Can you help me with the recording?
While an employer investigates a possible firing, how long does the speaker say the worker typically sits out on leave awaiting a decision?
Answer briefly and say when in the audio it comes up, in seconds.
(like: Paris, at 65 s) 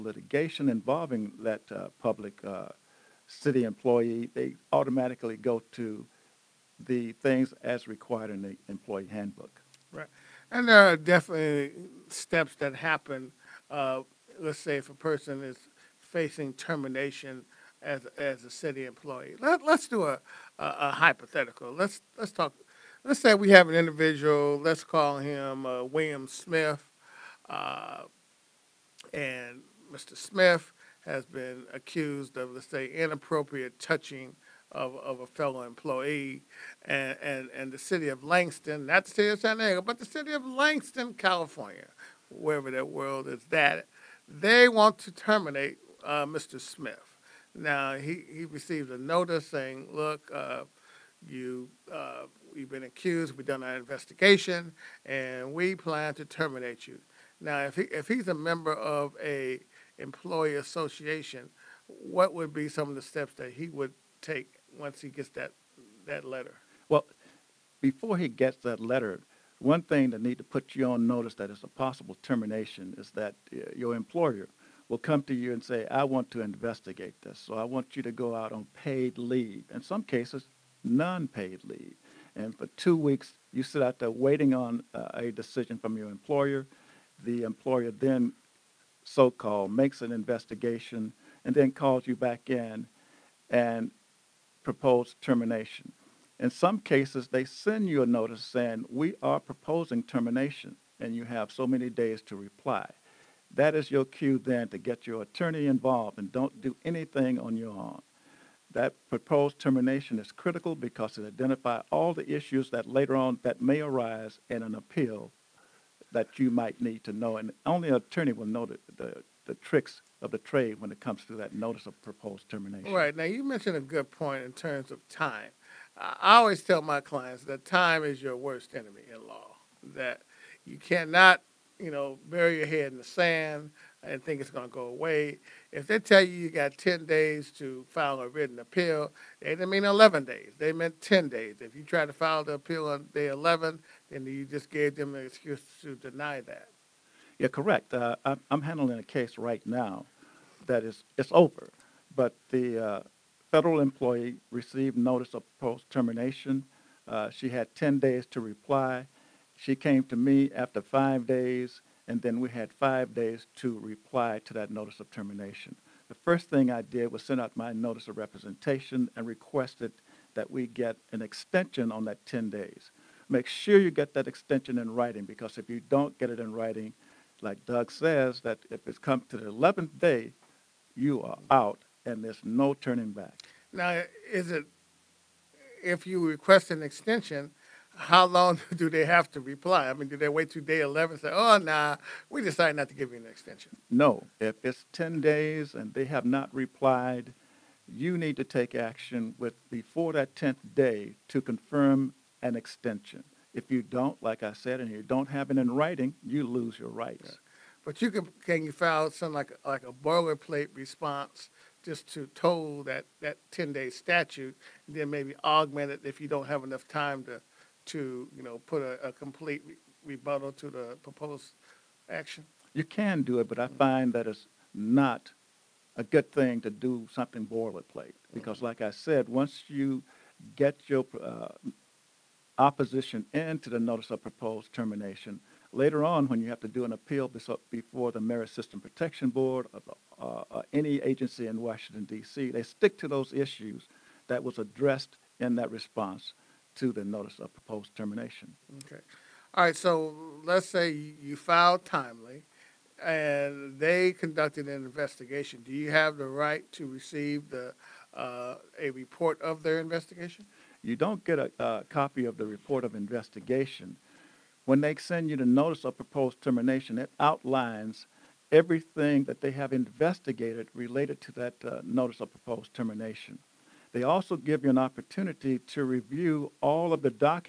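two weeks, at 82 s.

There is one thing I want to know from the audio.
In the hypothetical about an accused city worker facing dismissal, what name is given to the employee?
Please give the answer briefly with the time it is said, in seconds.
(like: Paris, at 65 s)
William Smith, at 25 s.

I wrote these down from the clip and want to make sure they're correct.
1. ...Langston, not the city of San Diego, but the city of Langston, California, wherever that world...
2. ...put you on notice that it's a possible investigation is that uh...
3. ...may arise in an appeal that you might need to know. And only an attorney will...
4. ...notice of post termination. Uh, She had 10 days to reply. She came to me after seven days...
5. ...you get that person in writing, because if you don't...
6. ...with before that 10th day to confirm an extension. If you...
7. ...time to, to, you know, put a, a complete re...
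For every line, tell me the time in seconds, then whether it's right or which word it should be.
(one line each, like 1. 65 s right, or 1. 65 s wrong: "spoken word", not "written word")
1. 38 s right
2. 70 s wrong: "termination", not "investigation"
3. 113 s right
4. 154 s wrong: "five", not "seven"
5. 173 s wrong: "extension", not "person"
6. 199 s right
7. 216 s right.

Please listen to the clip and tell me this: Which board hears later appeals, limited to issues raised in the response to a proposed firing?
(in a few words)
Merit System Protection Board.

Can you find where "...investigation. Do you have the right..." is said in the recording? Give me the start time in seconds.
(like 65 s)
254 s.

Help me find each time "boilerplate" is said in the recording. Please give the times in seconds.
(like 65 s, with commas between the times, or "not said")
209 s, 227 s.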